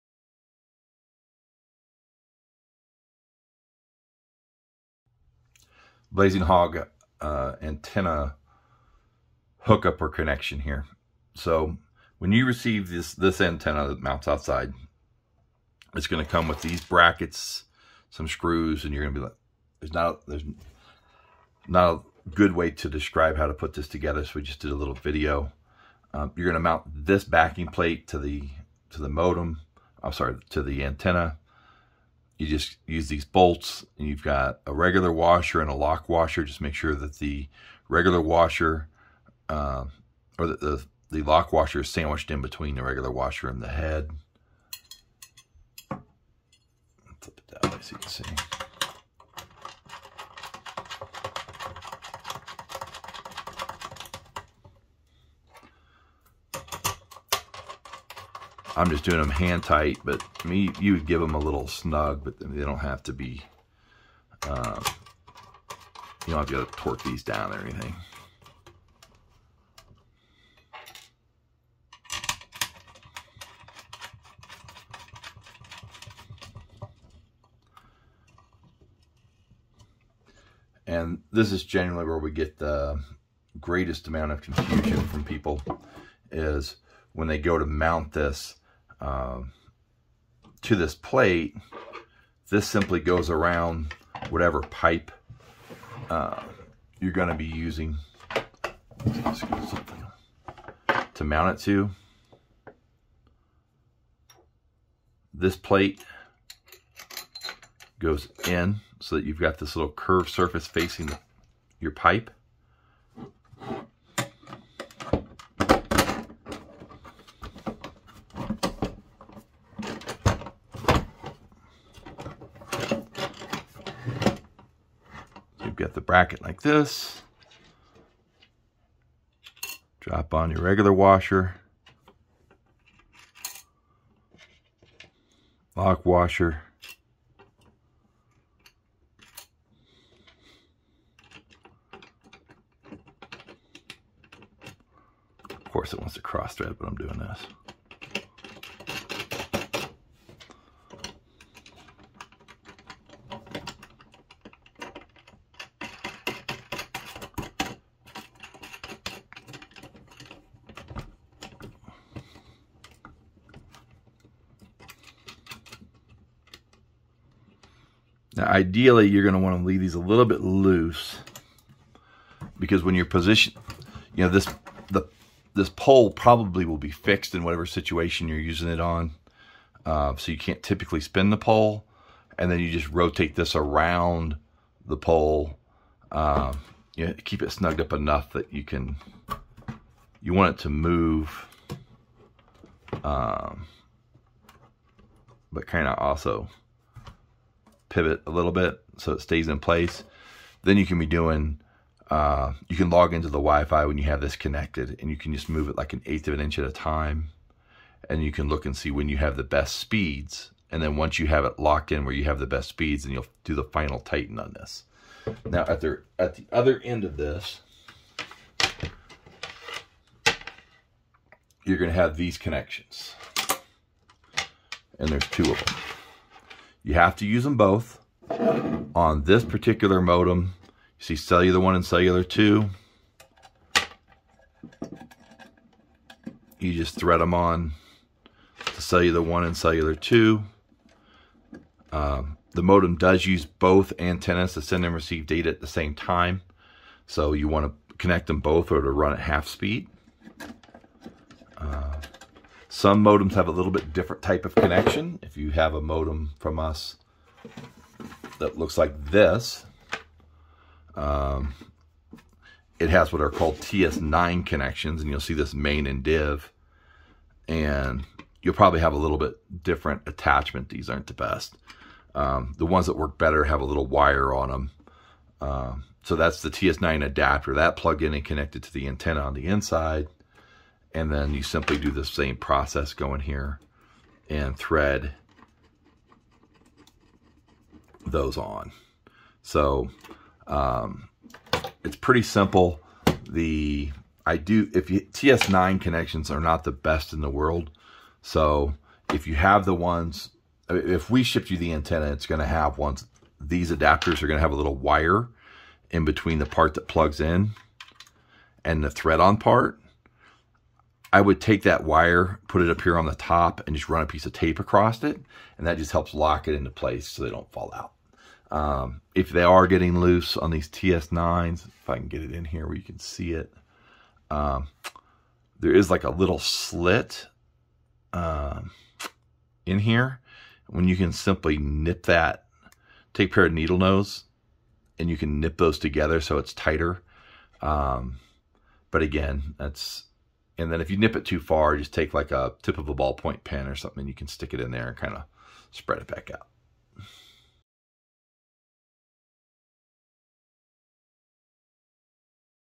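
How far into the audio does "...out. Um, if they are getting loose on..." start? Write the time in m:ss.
5:17.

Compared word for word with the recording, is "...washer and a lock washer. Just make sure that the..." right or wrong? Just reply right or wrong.
right.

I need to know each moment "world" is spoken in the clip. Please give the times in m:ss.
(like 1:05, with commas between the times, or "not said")
4:57.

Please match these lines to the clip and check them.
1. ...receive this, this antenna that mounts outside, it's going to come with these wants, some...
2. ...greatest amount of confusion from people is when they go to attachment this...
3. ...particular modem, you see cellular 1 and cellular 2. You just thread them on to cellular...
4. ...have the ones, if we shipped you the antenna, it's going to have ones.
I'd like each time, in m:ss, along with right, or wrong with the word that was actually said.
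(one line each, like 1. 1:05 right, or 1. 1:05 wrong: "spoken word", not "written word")
1. 0:12 wrong: "brackets", not "wants"
2. 1:23 wrong: "mount", not "attachment"
3. 3:49 right
4. 4:59 right.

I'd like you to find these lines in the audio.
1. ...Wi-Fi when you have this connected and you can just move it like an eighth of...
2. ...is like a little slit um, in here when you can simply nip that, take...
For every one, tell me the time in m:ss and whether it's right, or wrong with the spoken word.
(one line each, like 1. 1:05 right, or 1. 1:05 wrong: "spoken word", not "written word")
1. 3:23 right
2. 5:25 right.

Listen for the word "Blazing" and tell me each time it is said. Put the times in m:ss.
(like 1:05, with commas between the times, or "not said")
0:06.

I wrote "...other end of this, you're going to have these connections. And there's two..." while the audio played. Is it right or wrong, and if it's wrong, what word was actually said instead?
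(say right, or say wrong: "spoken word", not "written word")
right.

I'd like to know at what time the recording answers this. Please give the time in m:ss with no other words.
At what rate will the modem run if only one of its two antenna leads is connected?
4:09.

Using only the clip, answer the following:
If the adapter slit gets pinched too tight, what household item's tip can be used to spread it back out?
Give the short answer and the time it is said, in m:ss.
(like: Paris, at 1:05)
ballpoint pen, at 5:42.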